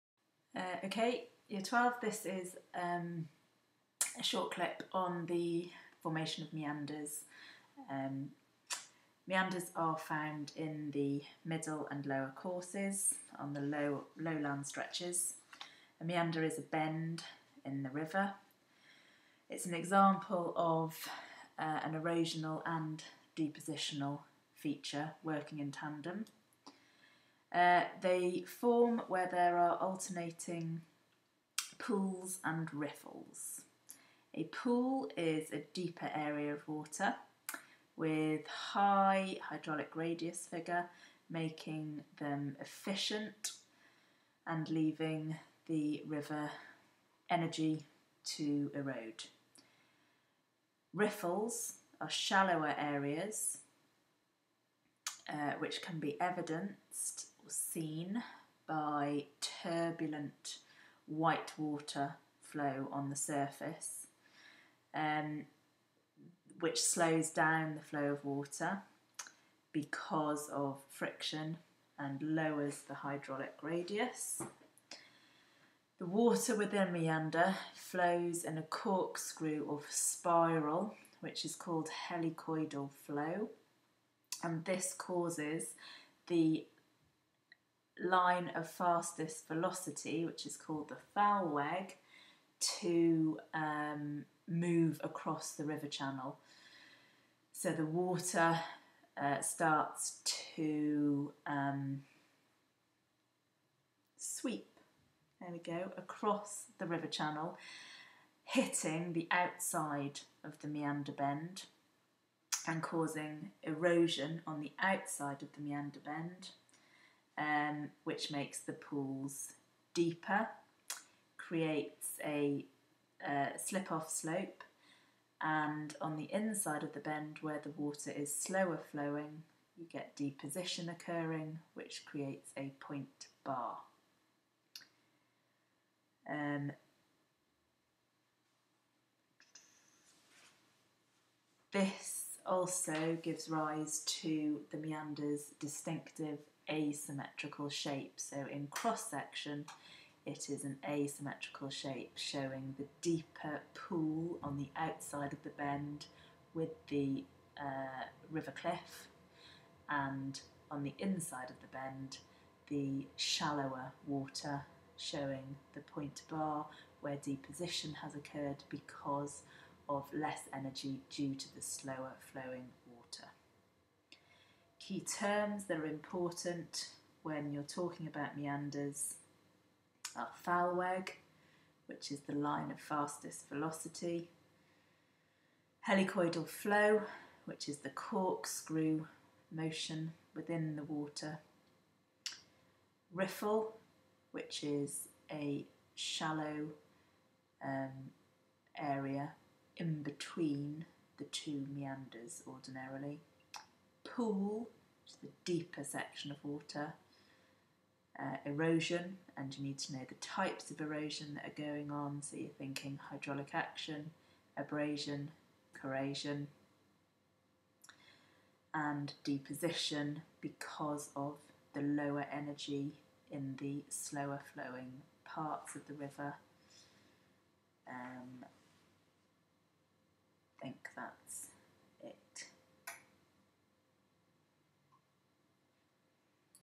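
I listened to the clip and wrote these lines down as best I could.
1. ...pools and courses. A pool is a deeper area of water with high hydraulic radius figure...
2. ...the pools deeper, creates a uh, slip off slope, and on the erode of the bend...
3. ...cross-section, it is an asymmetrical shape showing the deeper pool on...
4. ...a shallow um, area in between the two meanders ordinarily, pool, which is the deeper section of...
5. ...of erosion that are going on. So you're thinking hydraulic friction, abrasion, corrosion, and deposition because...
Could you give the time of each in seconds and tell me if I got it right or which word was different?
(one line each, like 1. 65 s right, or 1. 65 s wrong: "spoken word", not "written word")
1. 31 s wrong: "riffles", not "courses"
2. 118 s wrong: "inside", not "erode"
3. 148 s right
4. 195 s right
5. 210 s wrong: "action", not "friction".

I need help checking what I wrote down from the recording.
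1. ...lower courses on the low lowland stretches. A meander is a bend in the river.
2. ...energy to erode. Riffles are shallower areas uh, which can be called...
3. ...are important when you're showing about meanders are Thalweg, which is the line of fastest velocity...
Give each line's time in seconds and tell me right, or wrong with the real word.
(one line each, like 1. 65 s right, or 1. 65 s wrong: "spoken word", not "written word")
1. 12 s right
2. 47 s wrong: "evidenced", not "called"
3. 175 s wrong: "talking", not "showing".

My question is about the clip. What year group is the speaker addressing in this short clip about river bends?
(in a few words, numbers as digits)
Year 12.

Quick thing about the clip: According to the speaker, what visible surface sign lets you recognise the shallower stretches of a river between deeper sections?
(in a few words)
Turbulent white water.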